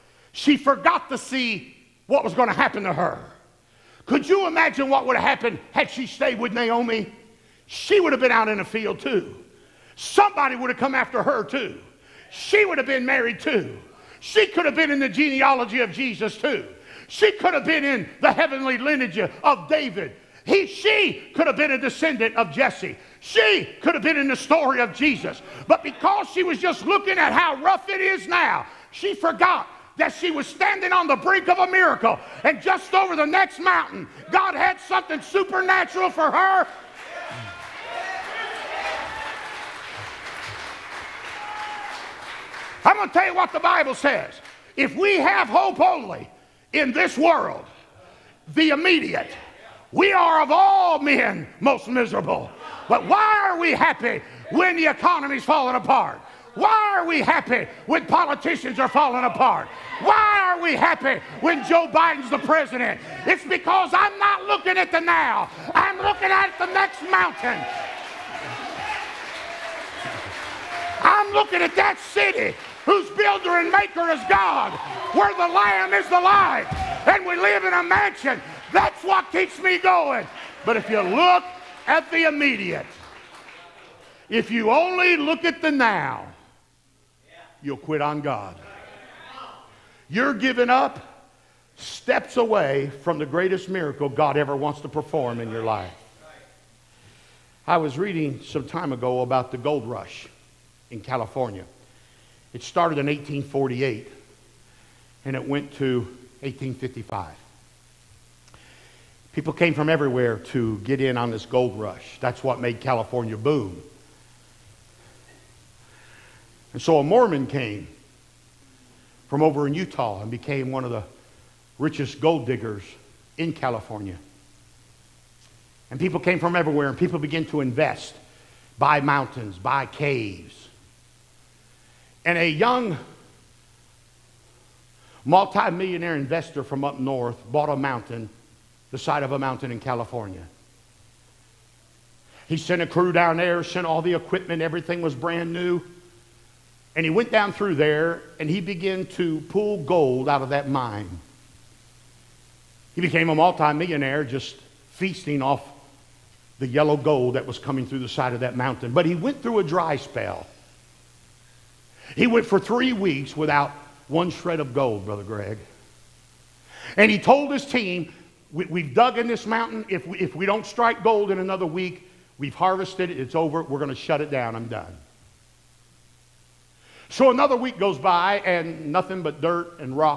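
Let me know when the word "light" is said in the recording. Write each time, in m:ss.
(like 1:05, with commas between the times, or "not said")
1:16.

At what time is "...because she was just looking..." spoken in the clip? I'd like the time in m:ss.
0:25.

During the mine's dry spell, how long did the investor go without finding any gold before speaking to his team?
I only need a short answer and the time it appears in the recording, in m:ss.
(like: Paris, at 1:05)
3 weeks, at 2:42.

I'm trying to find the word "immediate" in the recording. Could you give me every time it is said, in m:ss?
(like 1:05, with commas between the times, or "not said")
0:48, 1:22.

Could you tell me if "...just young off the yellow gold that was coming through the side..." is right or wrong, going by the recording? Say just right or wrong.
wrong.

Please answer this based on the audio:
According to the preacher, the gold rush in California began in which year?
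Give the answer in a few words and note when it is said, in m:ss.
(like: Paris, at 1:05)
1848, at 1:43.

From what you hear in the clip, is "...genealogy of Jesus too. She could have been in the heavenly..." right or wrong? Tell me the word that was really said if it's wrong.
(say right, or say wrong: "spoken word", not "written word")
right.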